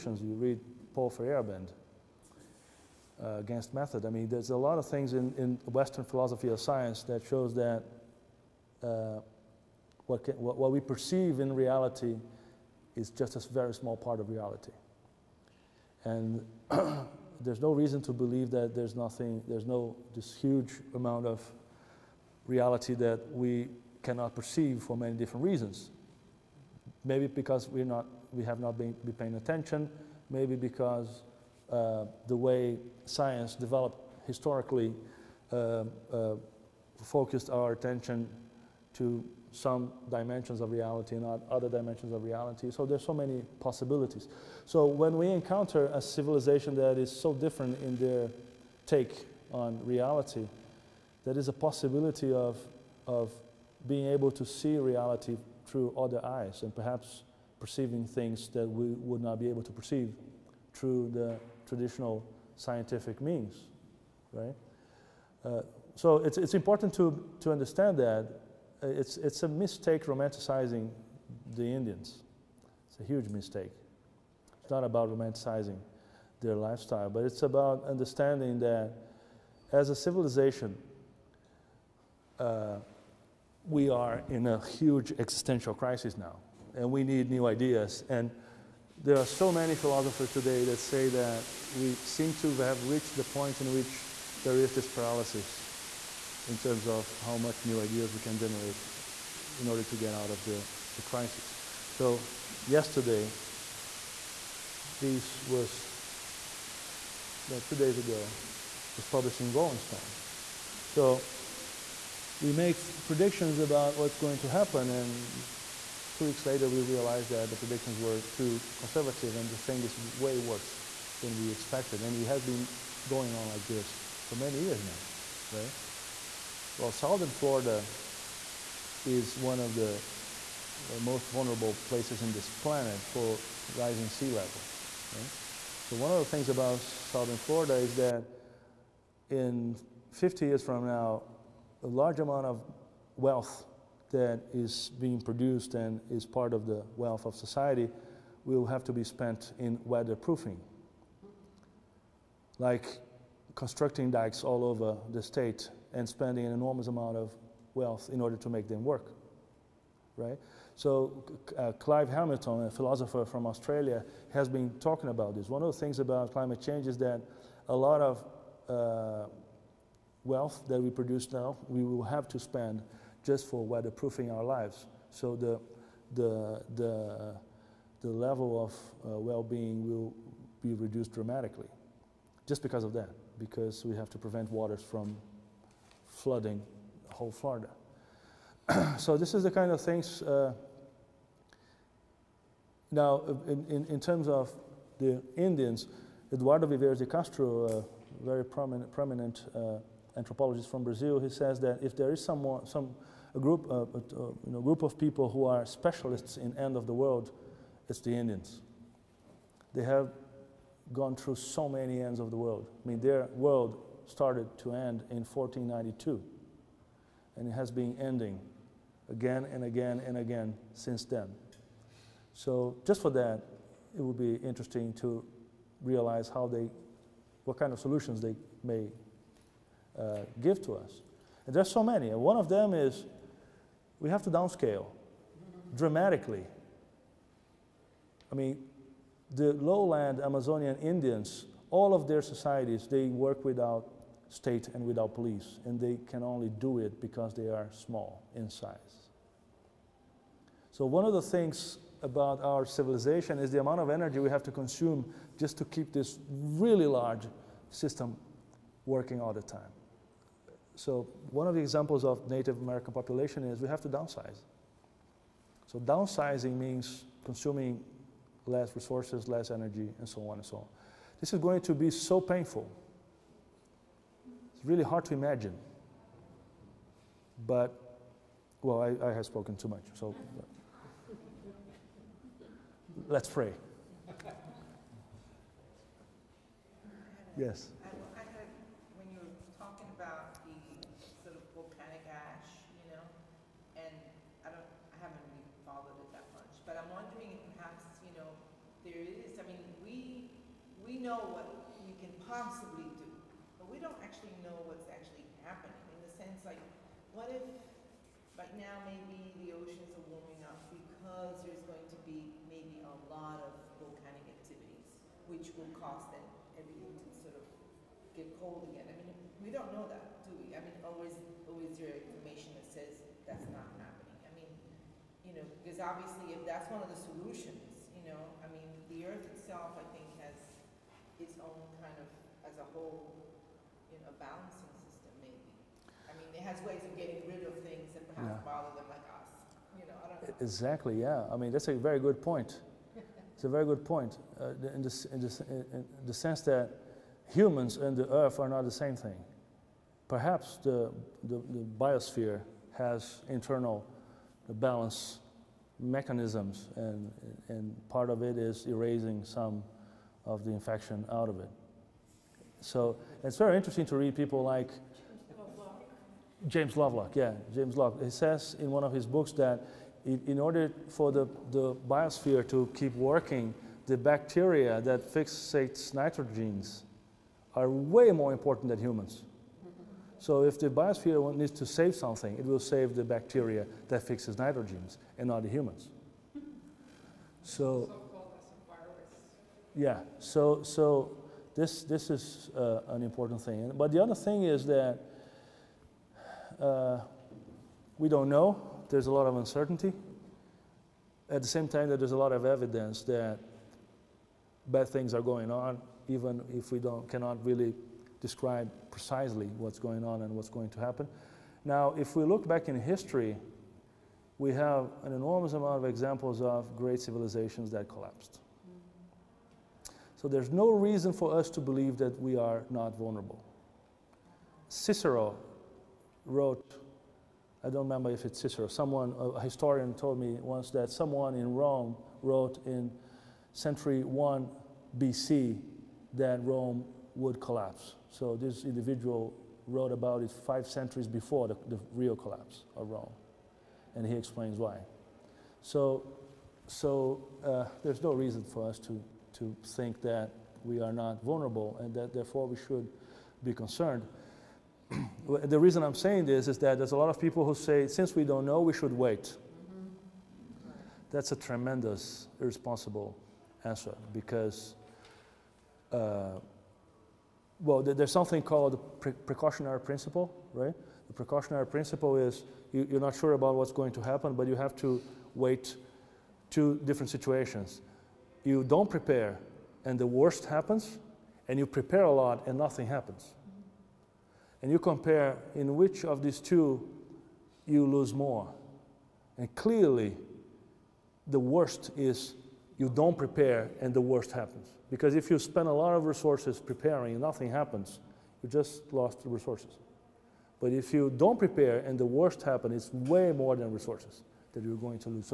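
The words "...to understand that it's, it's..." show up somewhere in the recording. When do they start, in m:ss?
1:07.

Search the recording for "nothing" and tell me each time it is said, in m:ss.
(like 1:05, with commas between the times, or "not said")
0:18, 8:02, 8:17.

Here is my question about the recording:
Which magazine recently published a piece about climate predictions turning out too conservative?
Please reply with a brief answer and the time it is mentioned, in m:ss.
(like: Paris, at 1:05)
Rolling Stone, at 1:49.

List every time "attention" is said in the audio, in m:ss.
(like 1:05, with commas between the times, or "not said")
0:29, 0:37.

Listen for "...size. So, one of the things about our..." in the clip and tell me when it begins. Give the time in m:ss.
4:08.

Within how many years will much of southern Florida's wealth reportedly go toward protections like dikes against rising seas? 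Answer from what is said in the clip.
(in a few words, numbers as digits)
50.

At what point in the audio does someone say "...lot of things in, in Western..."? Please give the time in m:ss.
0:04.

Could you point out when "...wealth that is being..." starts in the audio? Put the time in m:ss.
2:23.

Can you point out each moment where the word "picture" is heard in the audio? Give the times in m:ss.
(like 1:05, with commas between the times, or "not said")
not said.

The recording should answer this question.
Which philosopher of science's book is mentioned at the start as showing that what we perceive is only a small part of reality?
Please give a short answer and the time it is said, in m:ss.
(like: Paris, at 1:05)
Paul Feyerabend, at 0:00.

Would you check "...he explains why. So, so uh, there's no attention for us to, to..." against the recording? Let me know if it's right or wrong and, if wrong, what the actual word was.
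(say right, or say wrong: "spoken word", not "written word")
wrong: "reason", not "attention".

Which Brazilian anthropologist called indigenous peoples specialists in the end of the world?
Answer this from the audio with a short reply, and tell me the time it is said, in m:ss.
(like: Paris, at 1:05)
Eduardo Viveros de Castro, at 3:16.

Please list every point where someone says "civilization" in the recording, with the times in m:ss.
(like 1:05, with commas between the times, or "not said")
0:46, 1:19, 4:12, 6:57.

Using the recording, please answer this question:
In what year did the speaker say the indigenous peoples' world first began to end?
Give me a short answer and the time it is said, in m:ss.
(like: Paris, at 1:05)
1492, at 3:35.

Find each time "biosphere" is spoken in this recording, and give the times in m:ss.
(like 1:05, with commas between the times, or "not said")
5:51, 6:11, 6:20.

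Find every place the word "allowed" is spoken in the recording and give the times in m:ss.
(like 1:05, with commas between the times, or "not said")
not said.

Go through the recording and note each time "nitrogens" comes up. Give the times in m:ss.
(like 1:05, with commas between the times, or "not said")
6:15, 6:24.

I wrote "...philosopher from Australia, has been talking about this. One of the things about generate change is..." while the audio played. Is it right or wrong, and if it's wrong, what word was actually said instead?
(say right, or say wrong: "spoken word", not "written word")
wrong: "climate", not "generate".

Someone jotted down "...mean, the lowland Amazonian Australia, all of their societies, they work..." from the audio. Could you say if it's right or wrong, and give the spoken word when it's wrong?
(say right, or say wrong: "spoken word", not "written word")
wrong: "Indians", not "Australia".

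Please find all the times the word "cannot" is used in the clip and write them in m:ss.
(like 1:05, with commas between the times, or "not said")
0:24, 6:47.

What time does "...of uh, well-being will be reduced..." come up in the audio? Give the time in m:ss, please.
2:58.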